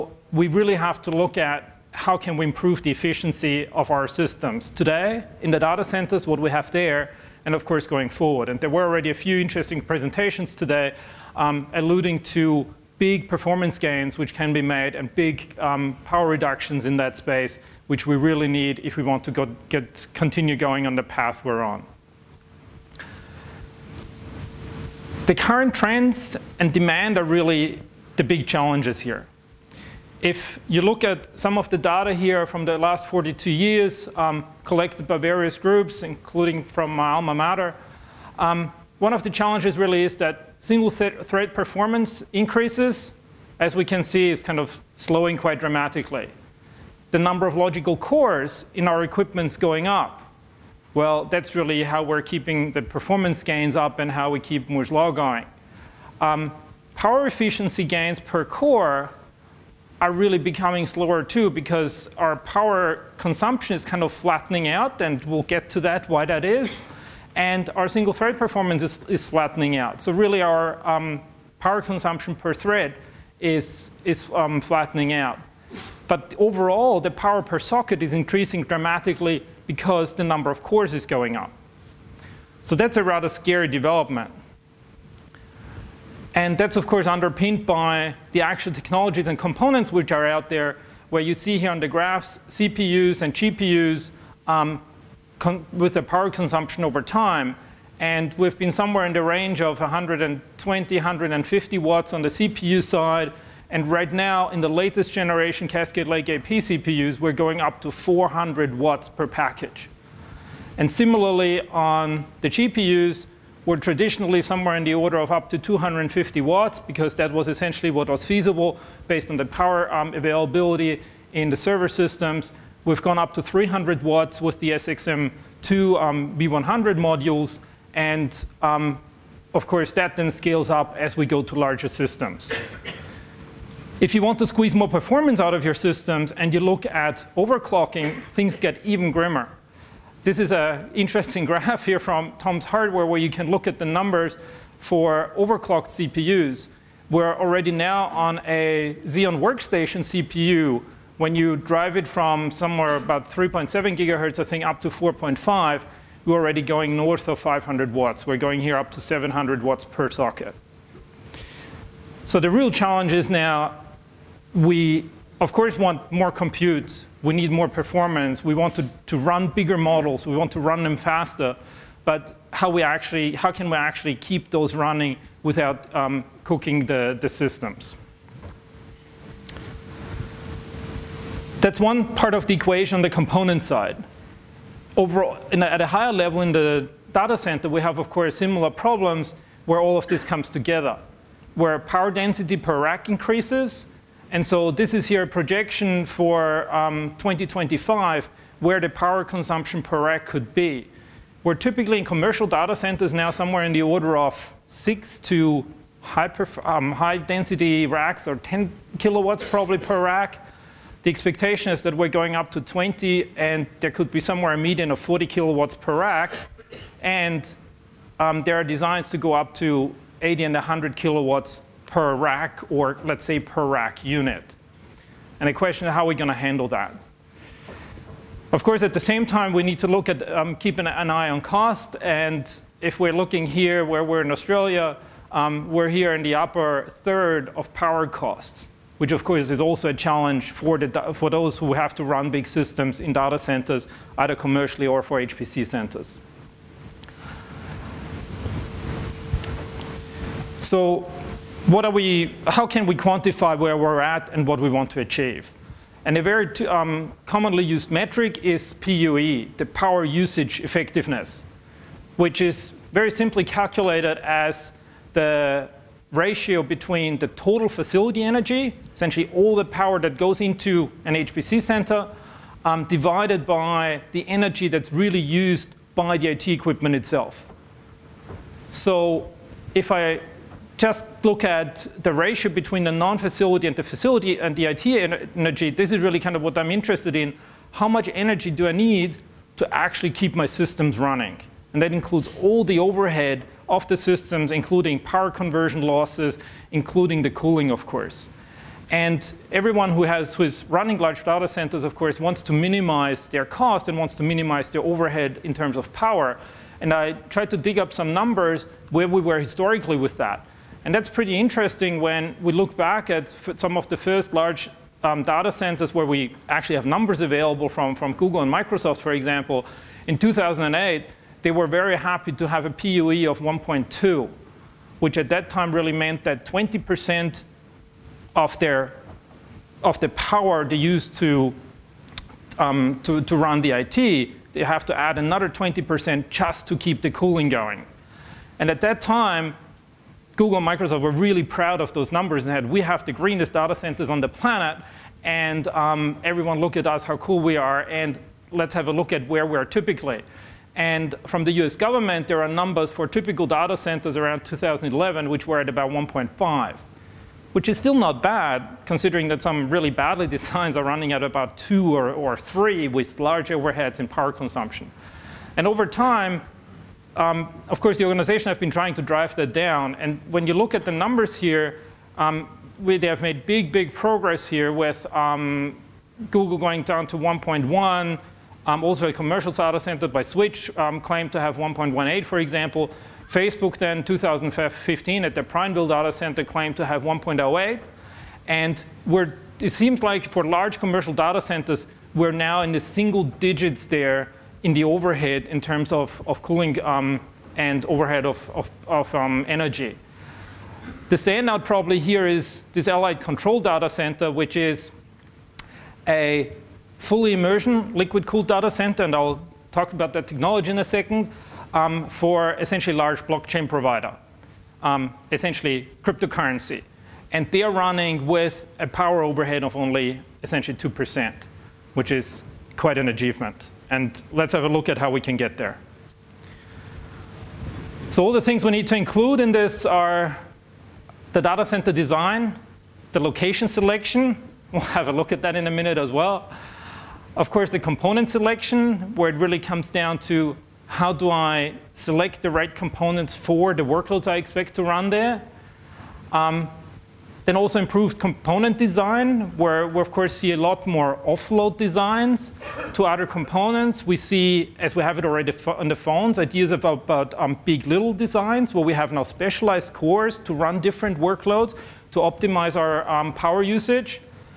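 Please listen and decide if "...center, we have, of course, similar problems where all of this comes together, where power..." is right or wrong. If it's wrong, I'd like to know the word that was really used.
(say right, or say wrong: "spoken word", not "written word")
right.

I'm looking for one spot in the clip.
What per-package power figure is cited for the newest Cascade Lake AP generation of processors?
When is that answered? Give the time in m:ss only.
1:47.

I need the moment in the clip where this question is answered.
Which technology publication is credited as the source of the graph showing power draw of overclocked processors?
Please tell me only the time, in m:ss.
2:22.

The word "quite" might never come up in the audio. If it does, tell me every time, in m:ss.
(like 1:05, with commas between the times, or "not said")
0:45, 7:02.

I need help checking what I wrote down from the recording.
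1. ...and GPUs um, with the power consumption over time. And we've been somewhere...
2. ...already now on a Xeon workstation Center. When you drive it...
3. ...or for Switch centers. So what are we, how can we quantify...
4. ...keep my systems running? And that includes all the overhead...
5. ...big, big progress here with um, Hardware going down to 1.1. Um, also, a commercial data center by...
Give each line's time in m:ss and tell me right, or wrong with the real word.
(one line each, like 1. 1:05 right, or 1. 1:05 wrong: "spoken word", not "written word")
1. 1:33 right
2. 2:27 wrong: "CPU", not "Center"
3. 4:04 wrong: "HPC", not "Switch"
4. 4:50 right
5. 6:13 wrong: "Google", not "Hardware".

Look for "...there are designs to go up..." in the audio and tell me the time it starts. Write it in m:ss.
3:38.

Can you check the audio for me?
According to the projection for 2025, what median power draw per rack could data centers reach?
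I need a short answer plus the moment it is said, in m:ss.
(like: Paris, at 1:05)
40 kilowatts, at 3:34.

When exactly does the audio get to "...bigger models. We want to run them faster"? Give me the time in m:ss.
2:49.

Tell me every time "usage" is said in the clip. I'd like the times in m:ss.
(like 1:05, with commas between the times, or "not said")
4:20, 7:43.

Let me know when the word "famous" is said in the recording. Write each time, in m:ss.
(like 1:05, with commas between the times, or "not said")
not said.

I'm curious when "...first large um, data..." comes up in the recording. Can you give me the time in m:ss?
5:13.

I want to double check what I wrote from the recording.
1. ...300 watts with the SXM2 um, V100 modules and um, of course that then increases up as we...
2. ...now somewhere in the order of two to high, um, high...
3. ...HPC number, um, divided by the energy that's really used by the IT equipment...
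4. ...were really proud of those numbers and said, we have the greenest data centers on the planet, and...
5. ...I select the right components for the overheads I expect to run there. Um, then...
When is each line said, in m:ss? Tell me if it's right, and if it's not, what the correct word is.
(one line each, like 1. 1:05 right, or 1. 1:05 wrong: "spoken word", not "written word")
1. 2:03 wrong: "scales", not "increases"
2. 3:23 wrong: "six", not "two"
3. 4:31 wrong: "center", not "number"
4. 5:41 right
5. 7:21 wrong: "workloads", not "overheads".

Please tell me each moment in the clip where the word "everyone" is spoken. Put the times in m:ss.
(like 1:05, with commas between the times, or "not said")
4:59, 5:46.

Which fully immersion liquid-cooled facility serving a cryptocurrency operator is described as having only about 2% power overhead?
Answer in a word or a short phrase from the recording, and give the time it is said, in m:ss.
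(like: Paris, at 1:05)
Allied Control, at 6:42.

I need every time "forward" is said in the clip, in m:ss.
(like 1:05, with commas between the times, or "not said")
0:08.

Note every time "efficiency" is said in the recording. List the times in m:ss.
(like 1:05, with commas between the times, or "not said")
0:02, 0:57.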